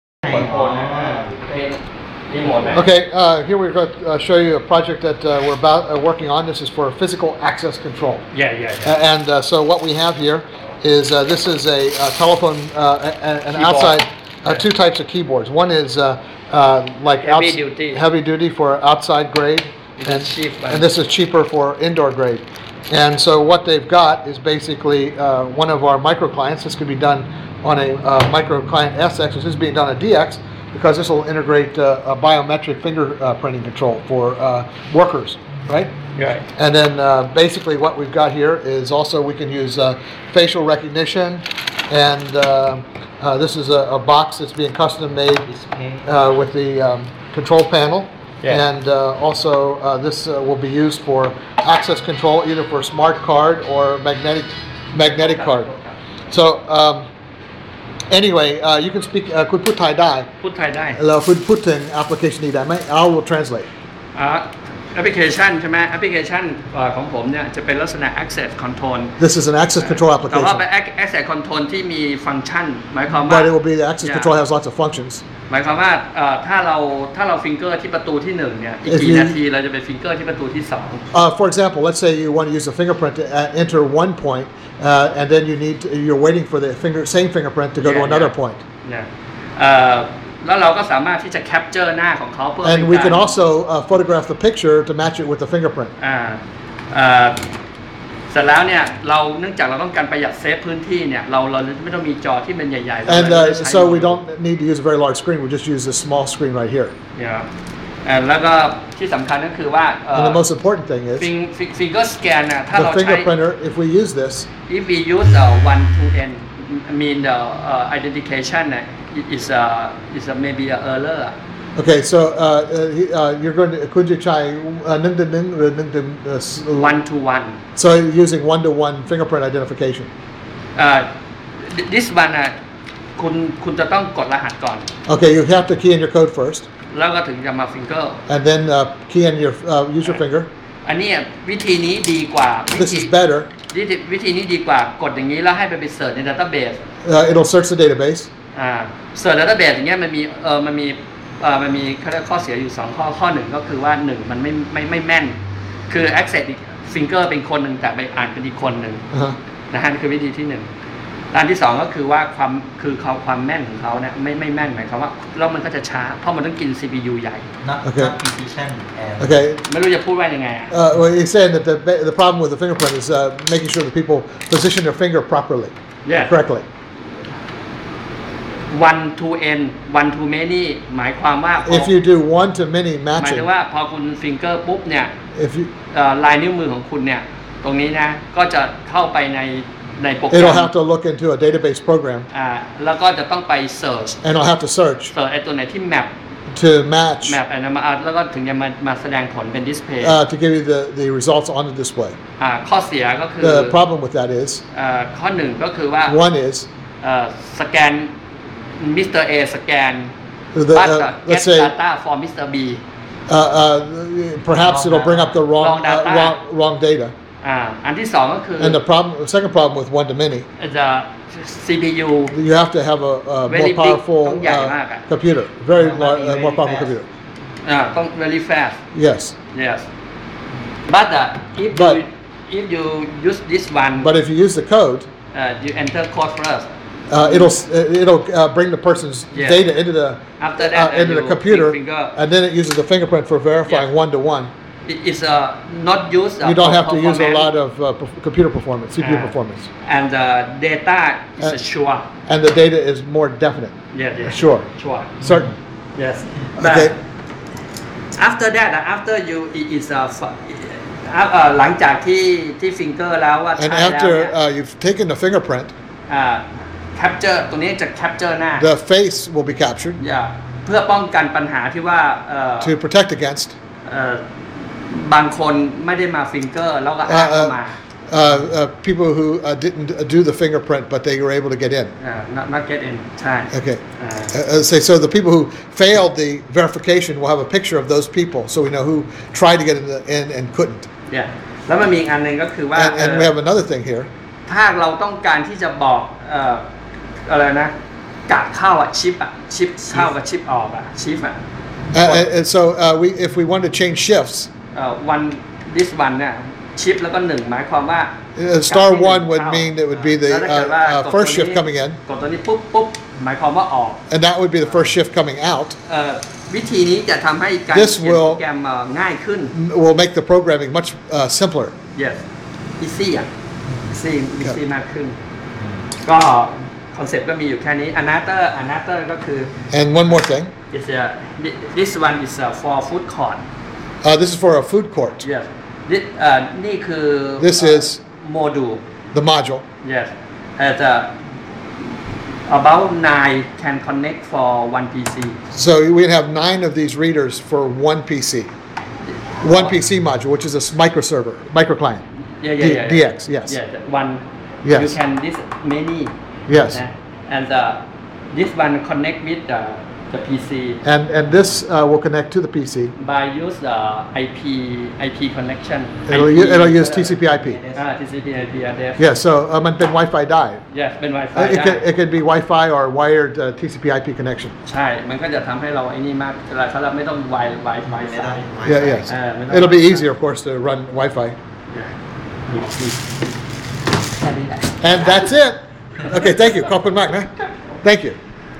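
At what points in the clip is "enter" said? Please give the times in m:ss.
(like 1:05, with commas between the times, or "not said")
1:23, 3:55.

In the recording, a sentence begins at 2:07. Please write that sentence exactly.
So using one to one fingerprint identification.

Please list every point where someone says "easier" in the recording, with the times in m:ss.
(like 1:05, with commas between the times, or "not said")
6:19.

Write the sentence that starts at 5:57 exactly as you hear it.
And uh, this one connect with the, the PC And, and this uh, will connect to the PC.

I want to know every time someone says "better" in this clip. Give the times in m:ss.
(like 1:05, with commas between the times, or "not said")
2:23.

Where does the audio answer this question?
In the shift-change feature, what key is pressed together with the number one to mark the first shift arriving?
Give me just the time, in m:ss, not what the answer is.
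5:08.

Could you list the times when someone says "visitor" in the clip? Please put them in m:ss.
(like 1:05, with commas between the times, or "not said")
not said.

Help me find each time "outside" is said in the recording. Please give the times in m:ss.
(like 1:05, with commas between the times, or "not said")
0:13, 0:18.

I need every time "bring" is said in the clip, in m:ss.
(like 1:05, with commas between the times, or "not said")
3:34, 3:58.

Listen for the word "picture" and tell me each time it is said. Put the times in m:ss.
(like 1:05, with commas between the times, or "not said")
1:34, 4:47.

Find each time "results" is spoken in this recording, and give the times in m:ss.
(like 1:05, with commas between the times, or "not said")
3:21.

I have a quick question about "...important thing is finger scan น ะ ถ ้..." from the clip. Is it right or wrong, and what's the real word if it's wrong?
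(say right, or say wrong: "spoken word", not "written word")
right.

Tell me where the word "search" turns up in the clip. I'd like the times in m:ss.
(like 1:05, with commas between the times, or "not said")
2:27, 3:14.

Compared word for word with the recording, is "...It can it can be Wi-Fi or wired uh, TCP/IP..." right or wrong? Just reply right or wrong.
right.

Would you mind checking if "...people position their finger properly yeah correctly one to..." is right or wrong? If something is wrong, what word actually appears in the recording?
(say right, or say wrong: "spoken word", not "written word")
right.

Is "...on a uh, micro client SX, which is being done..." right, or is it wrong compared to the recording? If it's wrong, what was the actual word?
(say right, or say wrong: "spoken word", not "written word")
right.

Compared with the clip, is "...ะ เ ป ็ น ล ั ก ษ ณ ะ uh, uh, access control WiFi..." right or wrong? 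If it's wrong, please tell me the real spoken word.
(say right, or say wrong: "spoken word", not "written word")
wrong: "This", not "WiFi".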